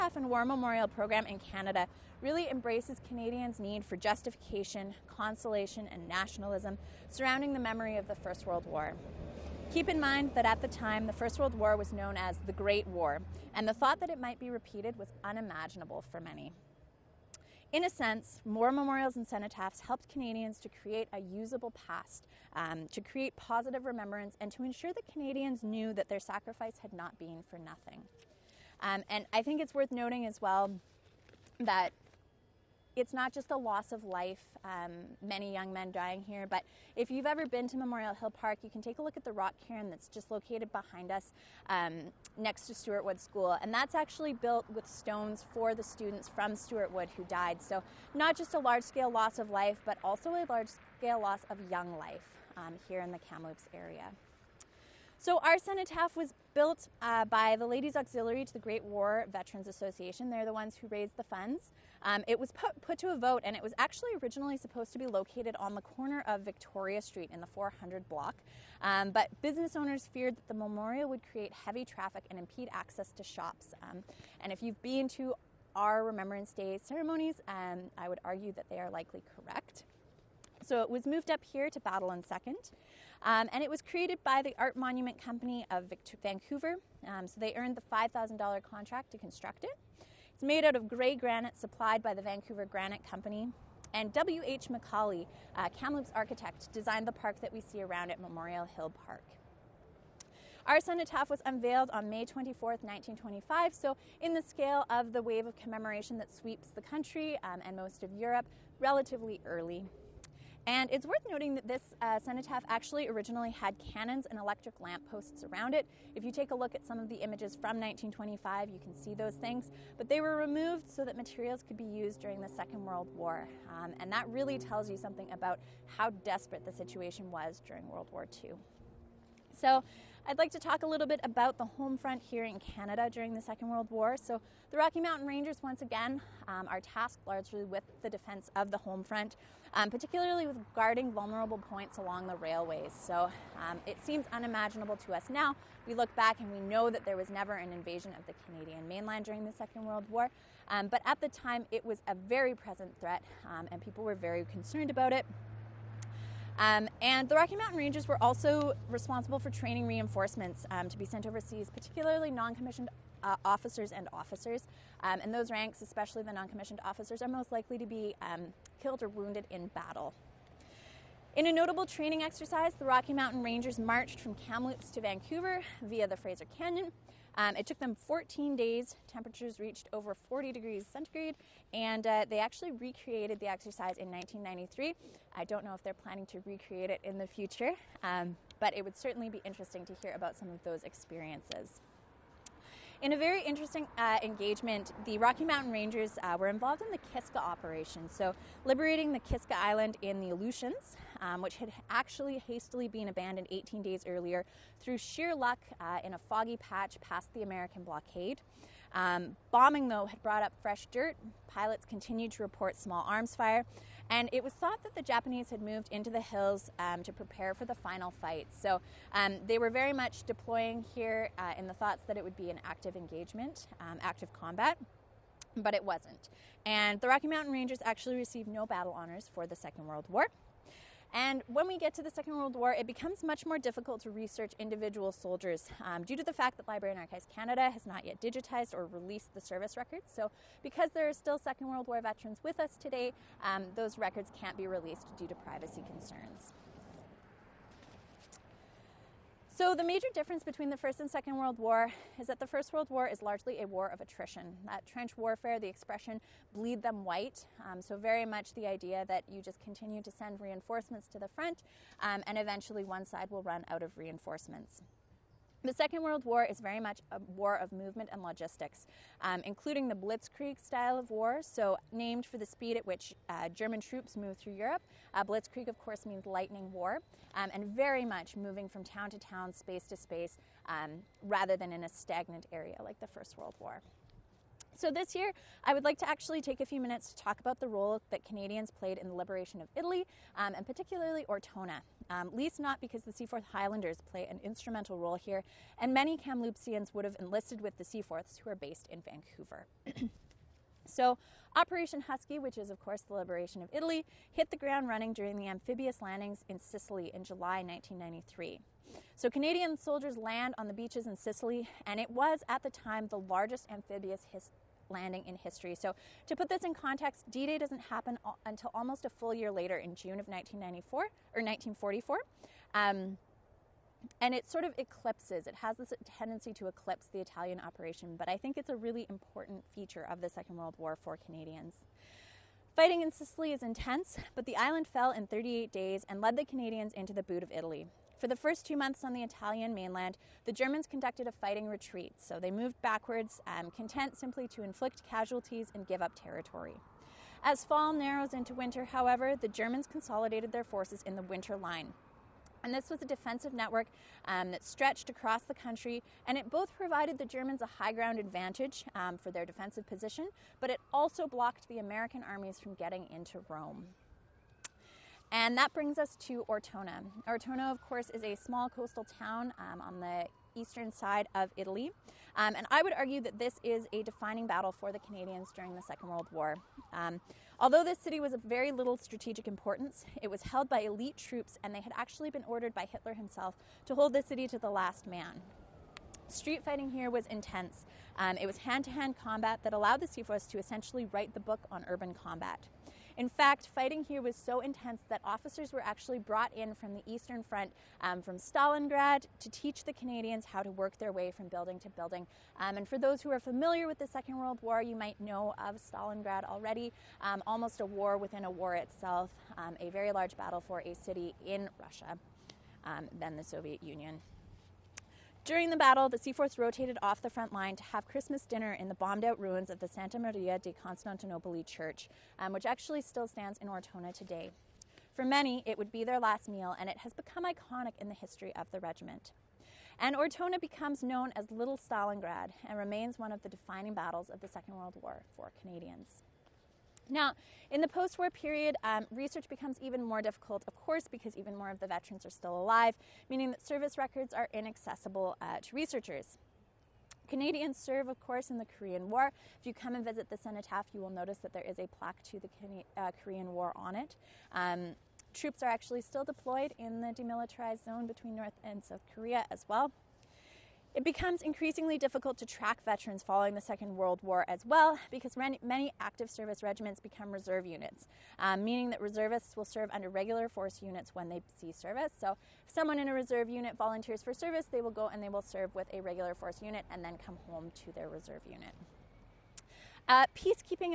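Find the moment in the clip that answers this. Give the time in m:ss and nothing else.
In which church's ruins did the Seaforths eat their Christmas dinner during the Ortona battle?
6:59.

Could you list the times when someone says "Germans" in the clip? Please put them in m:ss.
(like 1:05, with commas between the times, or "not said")
4:33, 5:40, 5:49, 5:57.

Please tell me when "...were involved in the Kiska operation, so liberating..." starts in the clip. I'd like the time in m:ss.
3:16.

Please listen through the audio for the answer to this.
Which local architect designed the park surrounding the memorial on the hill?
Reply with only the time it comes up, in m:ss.
1:34.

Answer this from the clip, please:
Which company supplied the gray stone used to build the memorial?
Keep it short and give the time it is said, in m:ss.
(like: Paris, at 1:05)
Vancouver Granite Company, at 1:32.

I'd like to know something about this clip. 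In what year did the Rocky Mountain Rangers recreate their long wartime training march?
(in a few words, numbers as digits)
1993.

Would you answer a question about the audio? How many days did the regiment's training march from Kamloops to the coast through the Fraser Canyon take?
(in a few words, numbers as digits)
14 days.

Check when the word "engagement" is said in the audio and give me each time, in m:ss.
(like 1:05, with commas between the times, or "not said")
3:14, 3:42.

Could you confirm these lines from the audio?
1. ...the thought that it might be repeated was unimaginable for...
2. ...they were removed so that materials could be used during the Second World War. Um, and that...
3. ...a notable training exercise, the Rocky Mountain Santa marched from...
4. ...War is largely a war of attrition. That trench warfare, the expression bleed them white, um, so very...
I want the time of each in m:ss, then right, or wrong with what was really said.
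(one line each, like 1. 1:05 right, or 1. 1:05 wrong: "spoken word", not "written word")
1. 0:13 right
2. 2:00 right
3. 2:51 wrong: "Rangers", not "Santa"
4. 4:12 right.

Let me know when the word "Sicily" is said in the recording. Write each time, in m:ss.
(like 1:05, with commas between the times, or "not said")
5:06, 5:11, 5:33.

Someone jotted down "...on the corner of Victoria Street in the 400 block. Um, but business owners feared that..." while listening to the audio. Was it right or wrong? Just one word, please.
right.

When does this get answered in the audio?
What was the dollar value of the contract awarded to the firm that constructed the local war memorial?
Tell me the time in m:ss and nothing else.
1:27.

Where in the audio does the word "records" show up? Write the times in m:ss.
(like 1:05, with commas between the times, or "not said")
3:59, 4:03, 7:23.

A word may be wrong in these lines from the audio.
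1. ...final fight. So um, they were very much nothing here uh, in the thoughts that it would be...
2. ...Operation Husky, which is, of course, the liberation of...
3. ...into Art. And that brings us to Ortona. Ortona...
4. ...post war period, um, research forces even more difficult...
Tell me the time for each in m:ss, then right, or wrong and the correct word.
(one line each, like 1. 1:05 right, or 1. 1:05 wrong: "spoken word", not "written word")
1. 3:37 wrong: "deploying", not "nothing"
2. 5:01 right
3. 6:03 wrong: "Rome", not "Art"
4. 7:17 wrong: "becomes", not "forces".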